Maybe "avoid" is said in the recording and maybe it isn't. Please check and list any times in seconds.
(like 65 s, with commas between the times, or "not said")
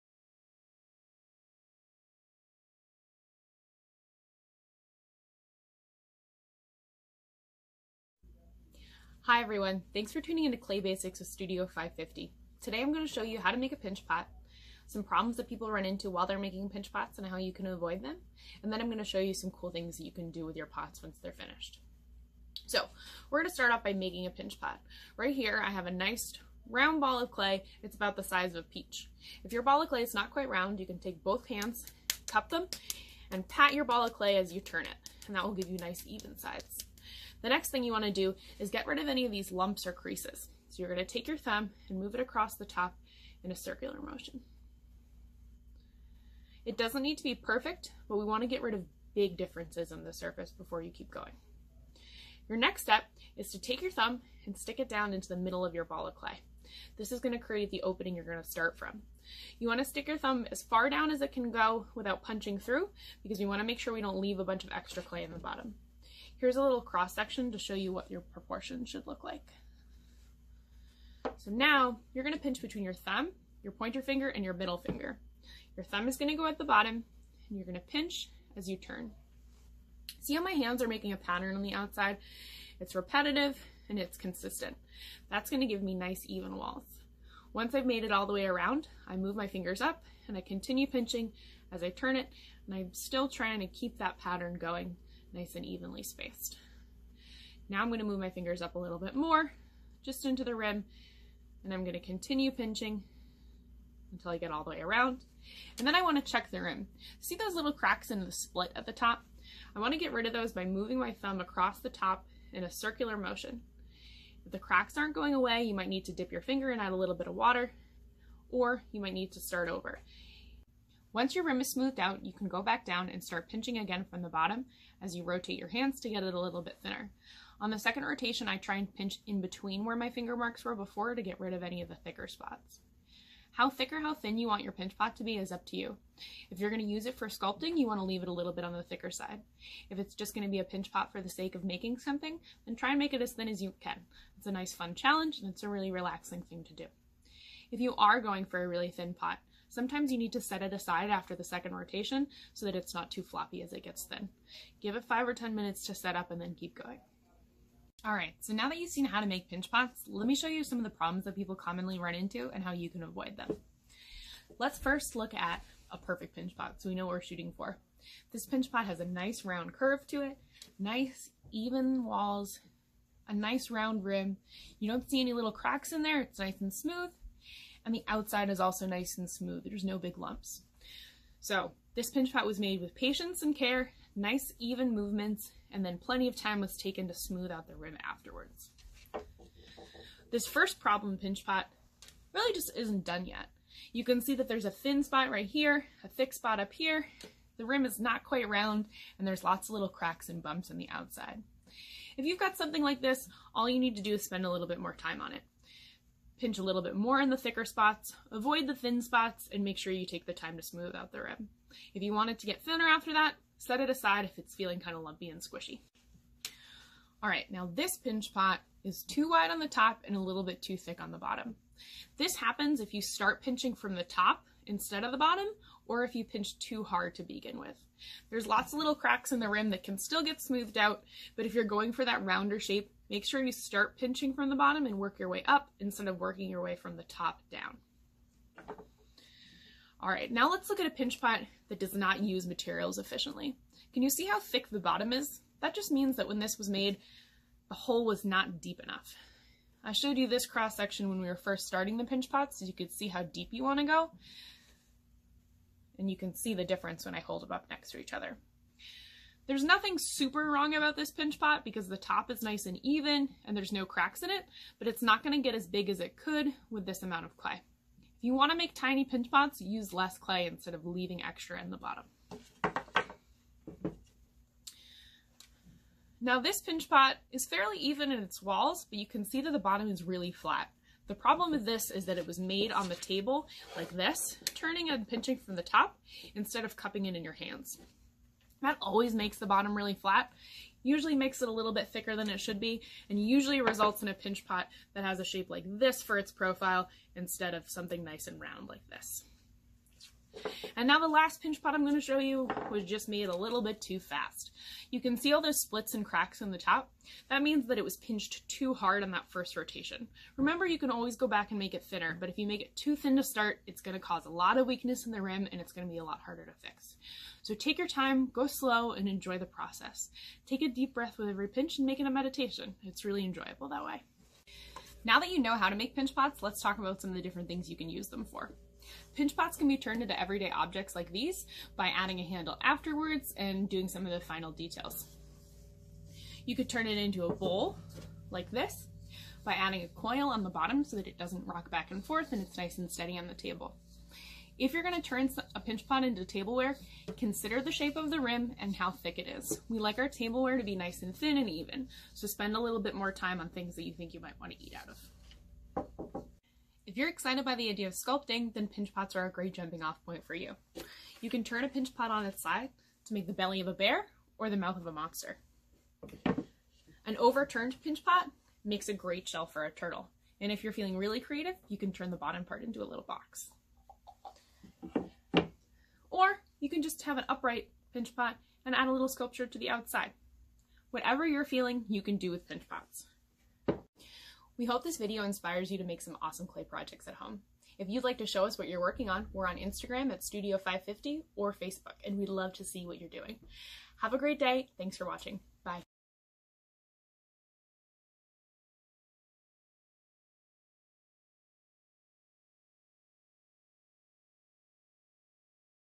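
17 s, 163 s, 208 s.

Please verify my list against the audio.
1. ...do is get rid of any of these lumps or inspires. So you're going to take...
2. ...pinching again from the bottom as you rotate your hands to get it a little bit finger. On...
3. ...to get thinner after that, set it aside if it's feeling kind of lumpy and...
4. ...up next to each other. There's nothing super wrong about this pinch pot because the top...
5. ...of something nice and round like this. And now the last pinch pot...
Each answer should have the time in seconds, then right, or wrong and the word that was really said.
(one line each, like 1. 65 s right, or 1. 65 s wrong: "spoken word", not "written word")
1. 38 s wrong: "creases", not "inspires"
2. 123 s wrong: "thinner", not "finger"
3. 212 s right
4. 257 s right
5. 297 s right.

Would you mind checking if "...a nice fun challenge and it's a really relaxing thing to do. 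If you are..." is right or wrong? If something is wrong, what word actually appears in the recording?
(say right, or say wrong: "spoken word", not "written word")
right.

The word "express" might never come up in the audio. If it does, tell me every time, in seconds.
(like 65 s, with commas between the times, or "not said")
not said.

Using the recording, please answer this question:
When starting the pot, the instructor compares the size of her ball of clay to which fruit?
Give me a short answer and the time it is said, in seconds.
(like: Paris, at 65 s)
a peach, at 28 s.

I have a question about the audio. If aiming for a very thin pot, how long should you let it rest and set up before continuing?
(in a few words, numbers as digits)
5 or 10 minutes.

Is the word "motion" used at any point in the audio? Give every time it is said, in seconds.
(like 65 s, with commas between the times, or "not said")
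43 s, 113 s.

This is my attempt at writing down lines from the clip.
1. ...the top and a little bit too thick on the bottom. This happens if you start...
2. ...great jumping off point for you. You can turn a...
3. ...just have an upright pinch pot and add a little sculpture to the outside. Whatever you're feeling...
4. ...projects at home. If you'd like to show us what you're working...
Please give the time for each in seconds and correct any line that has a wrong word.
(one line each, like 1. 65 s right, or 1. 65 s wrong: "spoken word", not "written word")
1. 219 s right
2. 359 s right
3. 376 s right
4. 386 s right.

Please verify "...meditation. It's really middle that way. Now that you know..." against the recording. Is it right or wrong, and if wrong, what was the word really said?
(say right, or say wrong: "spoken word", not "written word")
wrong: "enjoyable", not "middle".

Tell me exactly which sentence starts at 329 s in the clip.
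Pinch pots can be turned into everyday objects like these by adding a handle afterwards and doing some of the final details.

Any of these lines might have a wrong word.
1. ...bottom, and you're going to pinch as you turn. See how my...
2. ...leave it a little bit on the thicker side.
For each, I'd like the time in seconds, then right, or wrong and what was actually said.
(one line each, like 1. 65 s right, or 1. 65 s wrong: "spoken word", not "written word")
1. 76 s right
2. 138 s right.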